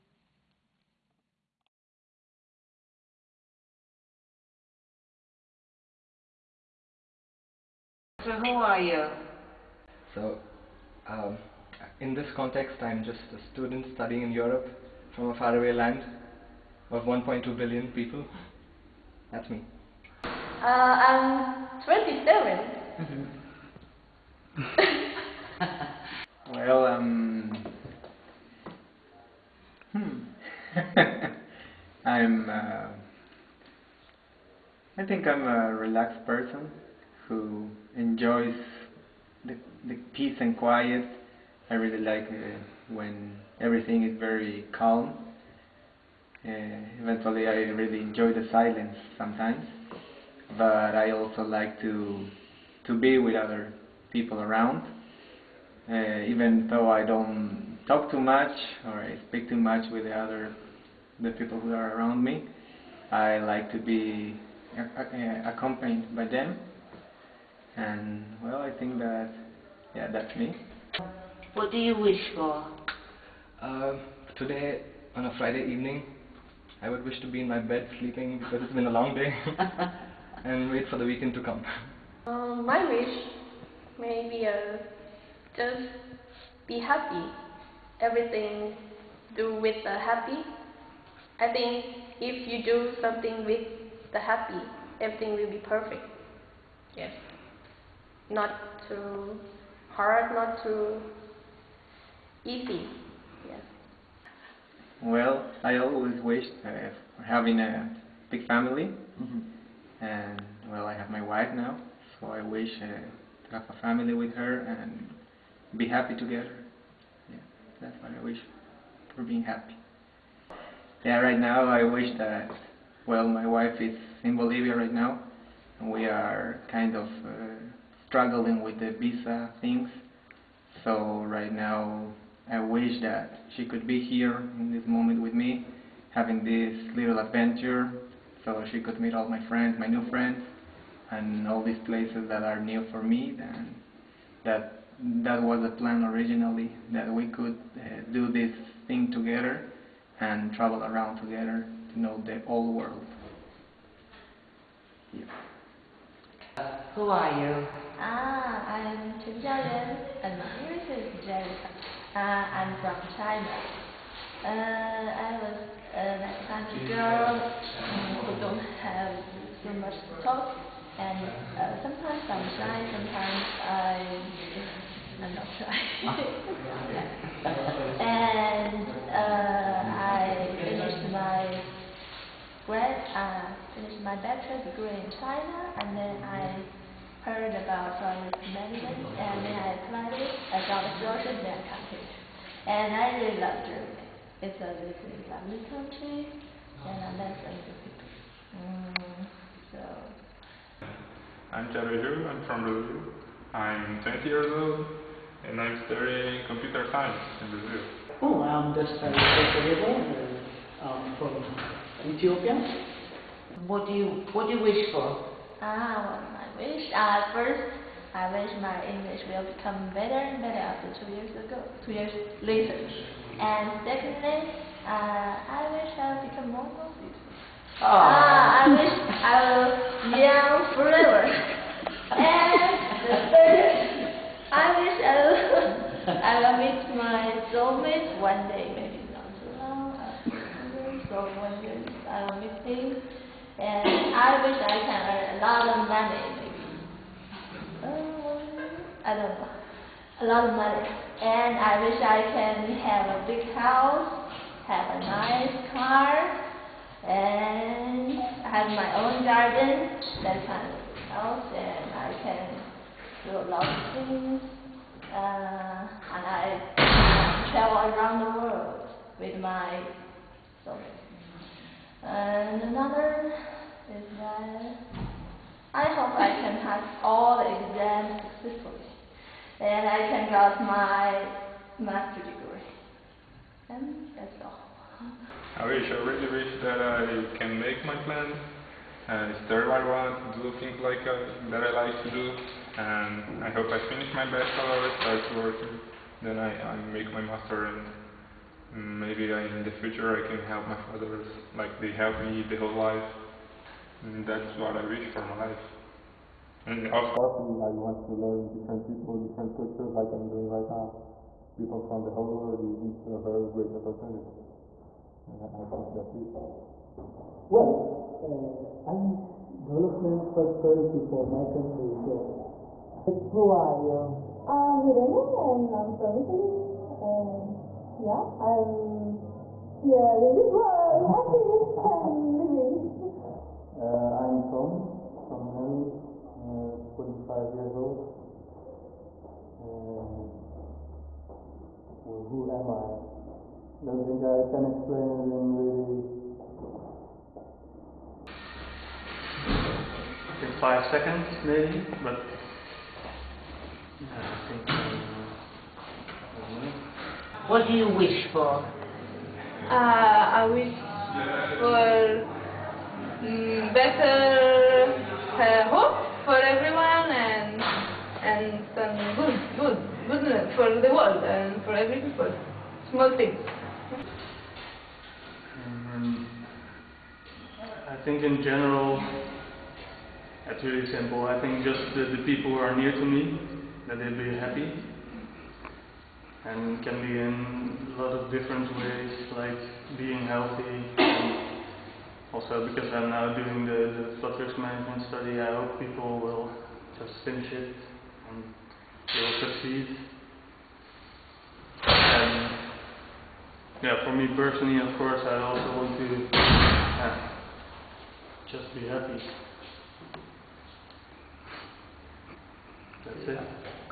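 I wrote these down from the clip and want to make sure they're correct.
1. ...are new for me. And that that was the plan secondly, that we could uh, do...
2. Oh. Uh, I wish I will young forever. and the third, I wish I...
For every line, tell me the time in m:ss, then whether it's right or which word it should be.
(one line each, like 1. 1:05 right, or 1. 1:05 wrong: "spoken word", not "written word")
1. 2:22 wrong: "originally", not "secondly"
2. 3:47 right.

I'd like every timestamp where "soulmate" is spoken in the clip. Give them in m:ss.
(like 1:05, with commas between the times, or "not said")
3:57.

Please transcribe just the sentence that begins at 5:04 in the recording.
And that's what I wish for my life.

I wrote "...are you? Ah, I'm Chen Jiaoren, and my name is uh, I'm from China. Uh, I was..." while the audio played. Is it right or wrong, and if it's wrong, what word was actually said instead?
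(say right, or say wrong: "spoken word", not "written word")
right.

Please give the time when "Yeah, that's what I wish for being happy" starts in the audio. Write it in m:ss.
1:57.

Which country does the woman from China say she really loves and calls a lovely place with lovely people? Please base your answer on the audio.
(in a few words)
Germany.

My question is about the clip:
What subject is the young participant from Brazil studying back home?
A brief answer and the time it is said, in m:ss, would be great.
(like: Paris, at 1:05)
computer science, at 3:26.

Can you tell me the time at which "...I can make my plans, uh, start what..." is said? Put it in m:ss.
4:46.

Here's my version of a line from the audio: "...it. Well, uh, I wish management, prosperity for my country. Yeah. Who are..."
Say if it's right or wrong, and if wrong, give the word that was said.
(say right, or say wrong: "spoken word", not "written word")
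wrong: "development", not "management".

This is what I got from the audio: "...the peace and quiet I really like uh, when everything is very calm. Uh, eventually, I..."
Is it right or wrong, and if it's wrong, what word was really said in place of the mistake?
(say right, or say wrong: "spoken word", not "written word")
right.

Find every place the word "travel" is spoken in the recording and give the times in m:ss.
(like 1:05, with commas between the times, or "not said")
2:30, 4:27.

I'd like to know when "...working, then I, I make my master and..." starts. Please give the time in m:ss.
4:55.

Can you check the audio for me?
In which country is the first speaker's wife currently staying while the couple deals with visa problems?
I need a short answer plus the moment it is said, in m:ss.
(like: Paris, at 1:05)
Bolivia, at 2:04.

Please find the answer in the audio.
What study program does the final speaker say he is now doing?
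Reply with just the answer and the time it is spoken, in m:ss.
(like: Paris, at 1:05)
risk management, at 6:34.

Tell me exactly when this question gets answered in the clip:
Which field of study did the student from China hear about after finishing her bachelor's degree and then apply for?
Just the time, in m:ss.
3:08.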